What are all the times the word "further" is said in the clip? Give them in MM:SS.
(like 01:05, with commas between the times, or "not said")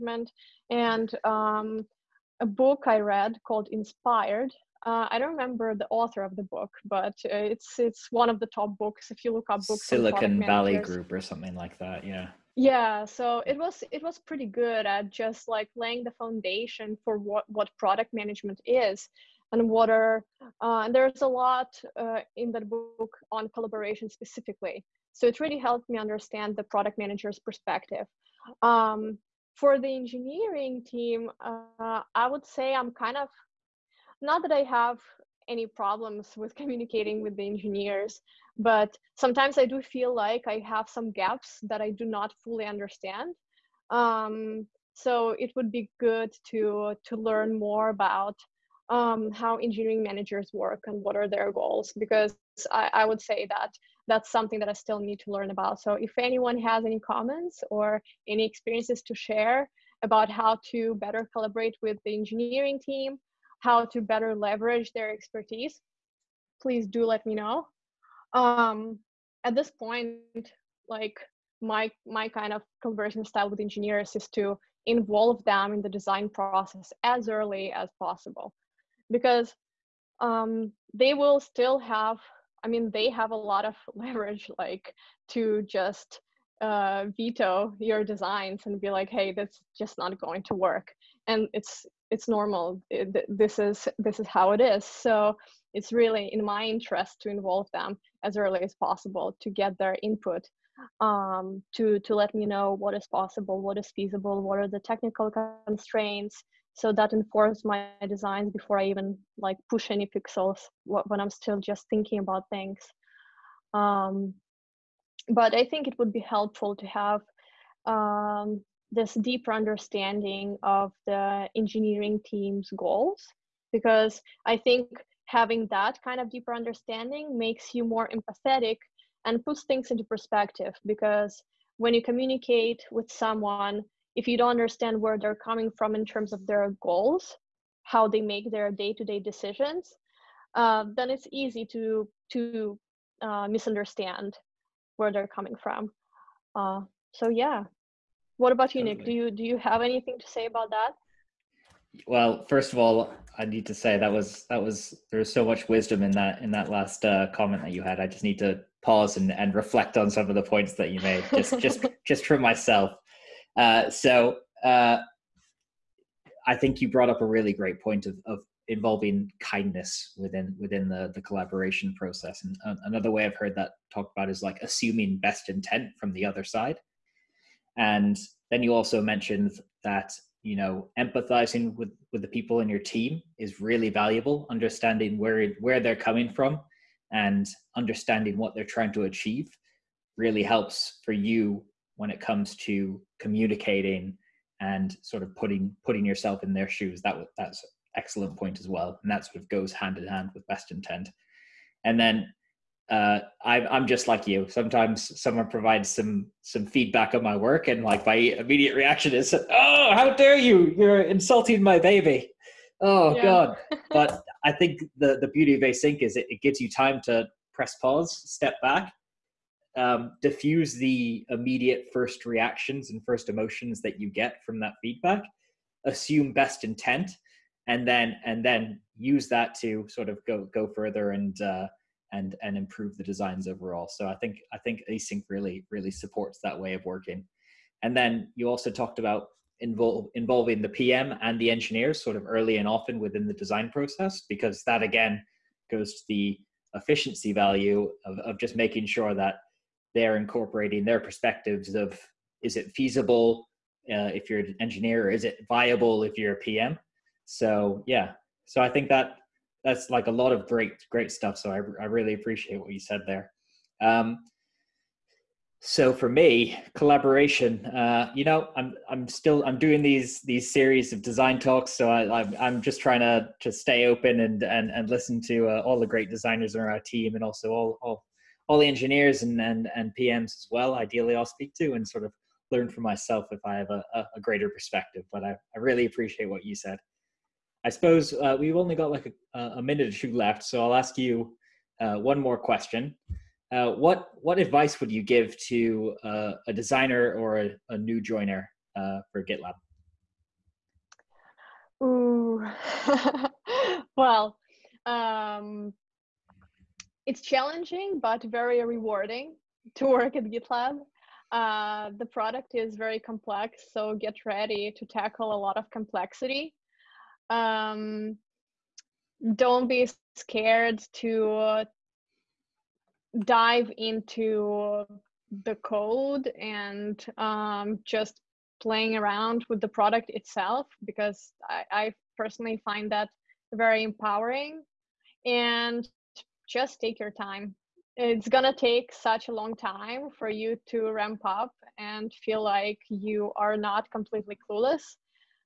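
03:50.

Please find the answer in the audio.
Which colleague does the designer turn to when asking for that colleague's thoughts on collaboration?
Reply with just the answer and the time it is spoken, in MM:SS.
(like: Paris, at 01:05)
Nick, at 02:28.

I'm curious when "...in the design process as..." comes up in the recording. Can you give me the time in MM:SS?
01:15.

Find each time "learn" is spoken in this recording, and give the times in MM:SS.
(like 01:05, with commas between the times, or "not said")
00:47, 00:55, 04:42.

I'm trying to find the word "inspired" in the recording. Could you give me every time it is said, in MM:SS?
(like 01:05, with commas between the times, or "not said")
00:03.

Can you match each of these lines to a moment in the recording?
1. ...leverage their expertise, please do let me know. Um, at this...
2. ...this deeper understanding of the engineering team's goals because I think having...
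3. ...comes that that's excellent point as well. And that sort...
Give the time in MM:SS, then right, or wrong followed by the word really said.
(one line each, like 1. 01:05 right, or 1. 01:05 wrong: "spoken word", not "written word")
1. 01:04 right
2. 01:58 right
3. 03:16 wrong: "shoes", not "comes".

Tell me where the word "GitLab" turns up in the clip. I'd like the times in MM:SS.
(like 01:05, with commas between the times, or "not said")
04:59, 05:10.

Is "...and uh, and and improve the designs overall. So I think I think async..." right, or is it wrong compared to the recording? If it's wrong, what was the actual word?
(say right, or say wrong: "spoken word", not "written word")
right.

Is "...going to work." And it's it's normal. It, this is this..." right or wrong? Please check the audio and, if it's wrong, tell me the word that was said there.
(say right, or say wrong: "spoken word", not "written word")
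right.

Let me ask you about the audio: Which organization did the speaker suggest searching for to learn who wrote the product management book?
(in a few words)
Silicon Valley Group.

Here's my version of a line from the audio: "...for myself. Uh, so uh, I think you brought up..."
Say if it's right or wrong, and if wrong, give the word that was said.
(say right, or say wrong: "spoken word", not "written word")
right.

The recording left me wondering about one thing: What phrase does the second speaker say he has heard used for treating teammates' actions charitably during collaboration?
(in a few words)
Assuming best intent.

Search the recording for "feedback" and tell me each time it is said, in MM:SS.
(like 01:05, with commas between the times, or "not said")
03:26, 03:44.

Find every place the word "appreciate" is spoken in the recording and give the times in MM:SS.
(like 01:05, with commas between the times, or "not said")
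04:22, 04:45.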